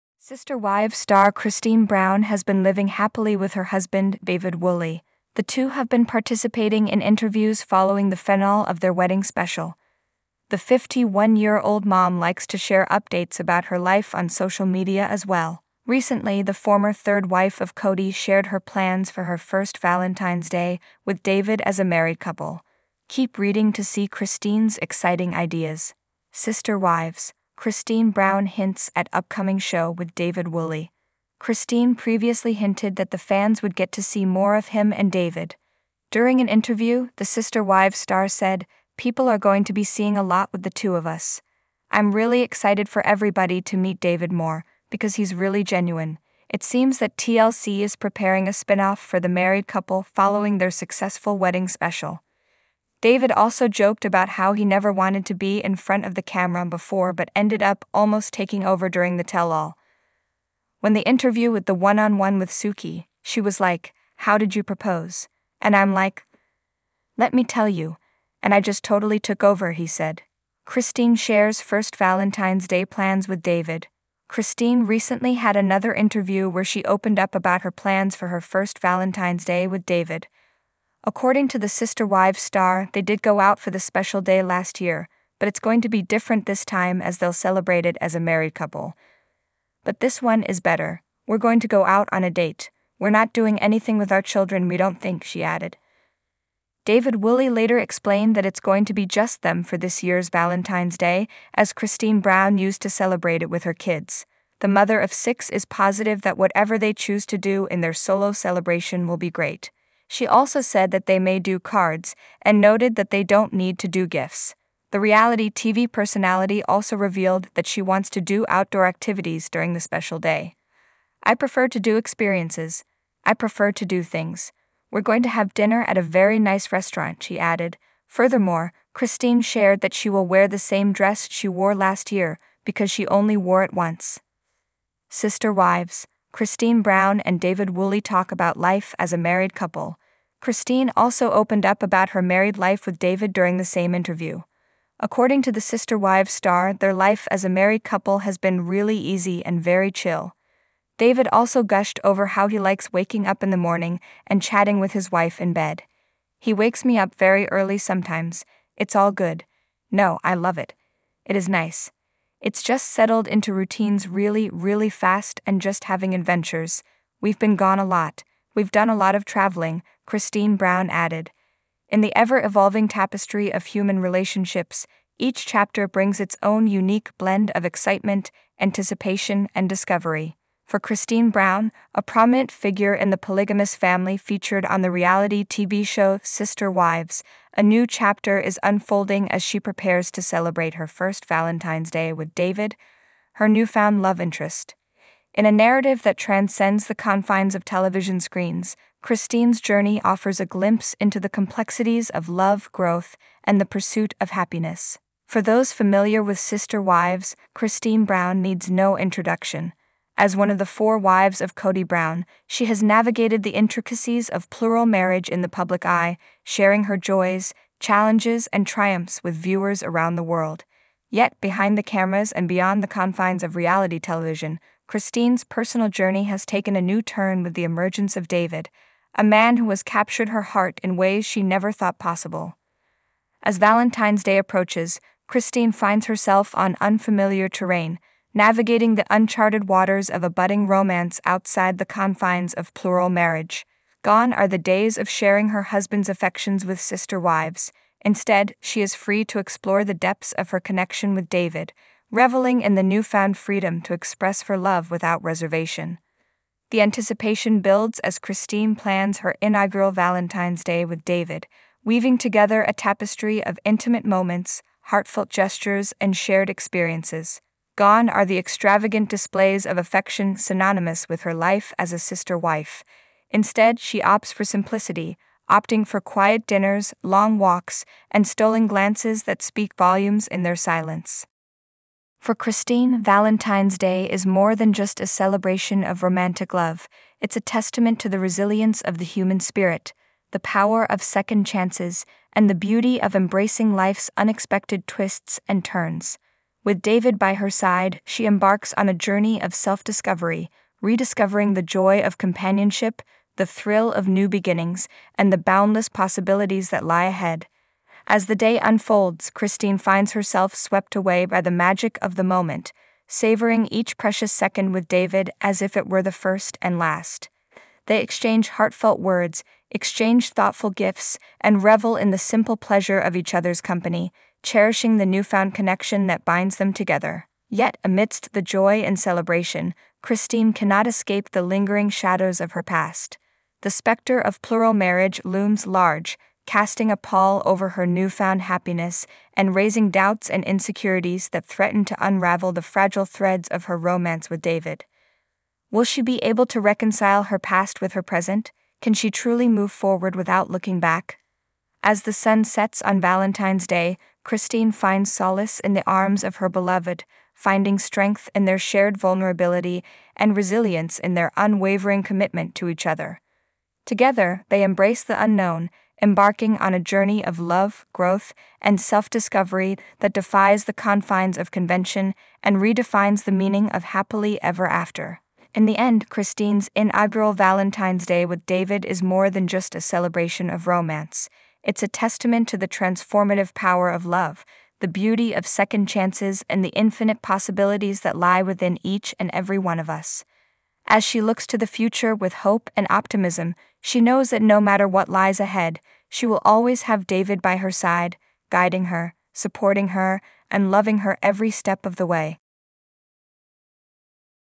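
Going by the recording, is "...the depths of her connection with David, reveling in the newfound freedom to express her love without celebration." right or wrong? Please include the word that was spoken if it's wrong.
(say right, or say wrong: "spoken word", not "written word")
wrong: "reservation", not "celebration".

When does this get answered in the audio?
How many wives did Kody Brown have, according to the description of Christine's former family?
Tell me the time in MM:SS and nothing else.
03:30.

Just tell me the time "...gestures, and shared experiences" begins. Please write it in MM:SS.
04:25.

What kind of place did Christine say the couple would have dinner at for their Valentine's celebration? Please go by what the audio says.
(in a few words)
a very nice restaurant.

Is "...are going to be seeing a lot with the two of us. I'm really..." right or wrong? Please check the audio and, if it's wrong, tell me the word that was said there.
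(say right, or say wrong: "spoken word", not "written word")
right.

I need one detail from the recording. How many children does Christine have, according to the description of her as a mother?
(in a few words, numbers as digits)
6.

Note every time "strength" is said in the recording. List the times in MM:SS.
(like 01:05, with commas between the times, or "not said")
05:57.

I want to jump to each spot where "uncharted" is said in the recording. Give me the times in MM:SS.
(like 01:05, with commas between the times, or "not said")
03:59.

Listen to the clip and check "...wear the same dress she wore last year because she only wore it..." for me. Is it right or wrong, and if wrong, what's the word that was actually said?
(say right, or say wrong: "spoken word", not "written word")
right.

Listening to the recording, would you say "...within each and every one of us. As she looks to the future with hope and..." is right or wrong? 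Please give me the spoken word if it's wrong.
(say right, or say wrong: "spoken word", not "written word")
right.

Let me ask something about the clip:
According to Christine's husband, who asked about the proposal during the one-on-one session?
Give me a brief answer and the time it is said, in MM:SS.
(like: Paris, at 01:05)
Suki, at 01:02.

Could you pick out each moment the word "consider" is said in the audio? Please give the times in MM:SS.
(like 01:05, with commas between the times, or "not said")
not said.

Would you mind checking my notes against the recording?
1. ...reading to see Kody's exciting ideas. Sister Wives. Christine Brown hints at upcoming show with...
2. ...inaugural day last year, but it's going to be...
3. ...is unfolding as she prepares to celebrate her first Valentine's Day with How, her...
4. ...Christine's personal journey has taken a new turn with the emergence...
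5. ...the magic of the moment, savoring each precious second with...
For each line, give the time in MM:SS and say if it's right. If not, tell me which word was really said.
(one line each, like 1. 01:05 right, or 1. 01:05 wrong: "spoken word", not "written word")
1. 00:23 wrong: "Christine", not "Kody"
2. 01:23 wrong: "special", not "inaugural"
3. 03:08 wrong: "David", not "How"
4. 03:44 right
5. 05:11 right.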